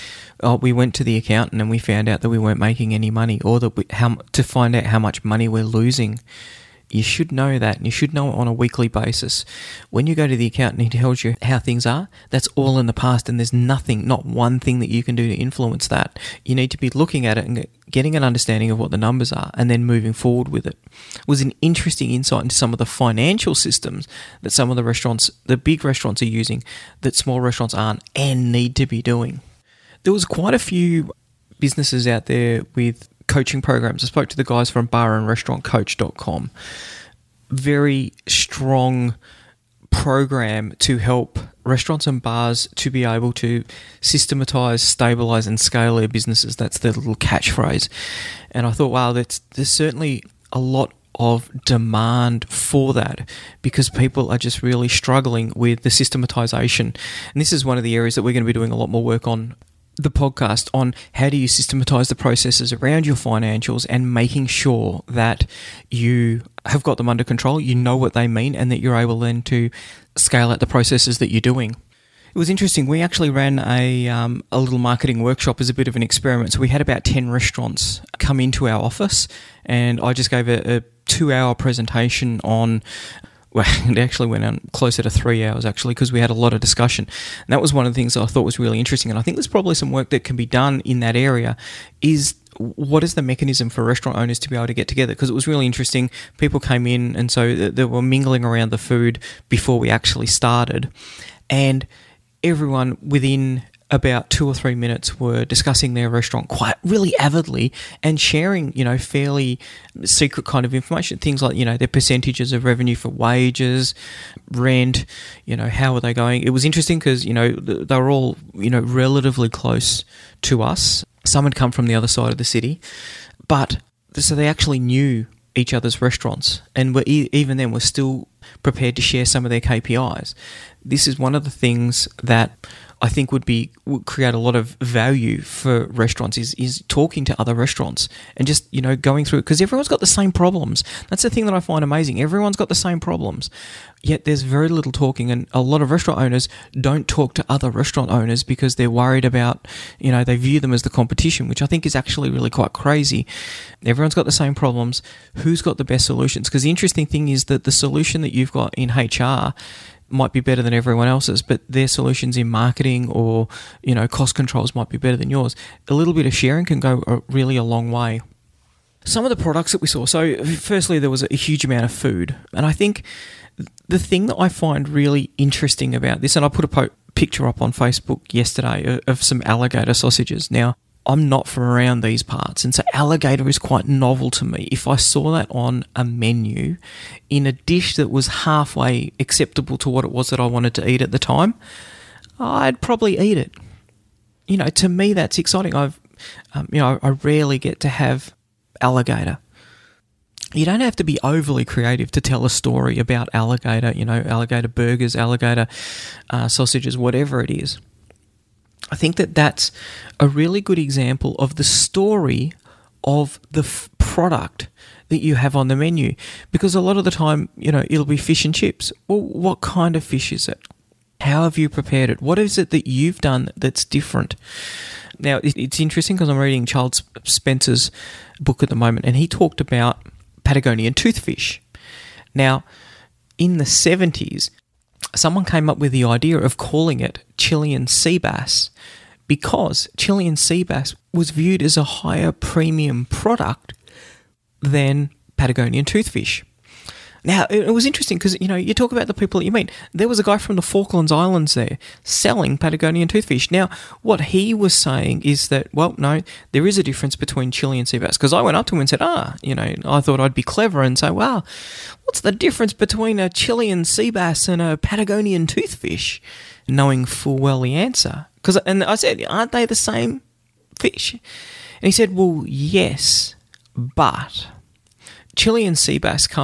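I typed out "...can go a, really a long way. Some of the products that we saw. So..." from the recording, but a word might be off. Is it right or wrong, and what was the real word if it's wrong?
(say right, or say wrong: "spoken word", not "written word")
right.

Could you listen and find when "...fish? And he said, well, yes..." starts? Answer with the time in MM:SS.
04:30.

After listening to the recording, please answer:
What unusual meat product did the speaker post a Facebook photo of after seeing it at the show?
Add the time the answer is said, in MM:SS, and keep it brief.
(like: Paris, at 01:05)
Alligator sausages, at 02:59.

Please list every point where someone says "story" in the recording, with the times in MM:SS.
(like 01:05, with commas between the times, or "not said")
03:22, 03:31.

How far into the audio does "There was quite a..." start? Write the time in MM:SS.
00:30.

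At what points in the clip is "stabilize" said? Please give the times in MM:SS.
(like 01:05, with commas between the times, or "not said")
00:44.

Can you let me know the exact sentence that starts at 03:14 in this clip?
You know, to me, that's exciting.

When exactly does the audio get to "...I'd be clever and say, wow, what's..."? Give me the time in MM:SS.
04:20.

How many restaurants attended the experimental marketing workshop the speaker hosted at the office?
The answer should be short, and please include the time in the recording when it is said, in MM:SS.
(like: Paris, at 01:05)
10, at 01:17.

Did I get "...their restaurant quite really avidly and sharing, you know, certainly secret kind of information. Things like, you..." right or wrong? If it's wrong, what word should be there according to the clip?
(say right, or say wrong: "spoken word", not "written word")
wrong: "fairly", not "certainly".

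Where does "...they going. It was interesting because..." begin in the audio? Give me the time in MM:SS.
01:56.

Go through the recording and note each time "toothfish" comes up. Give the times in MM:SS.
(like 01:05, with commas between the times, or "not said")
03:50, 04:05, 04:13, 04:25.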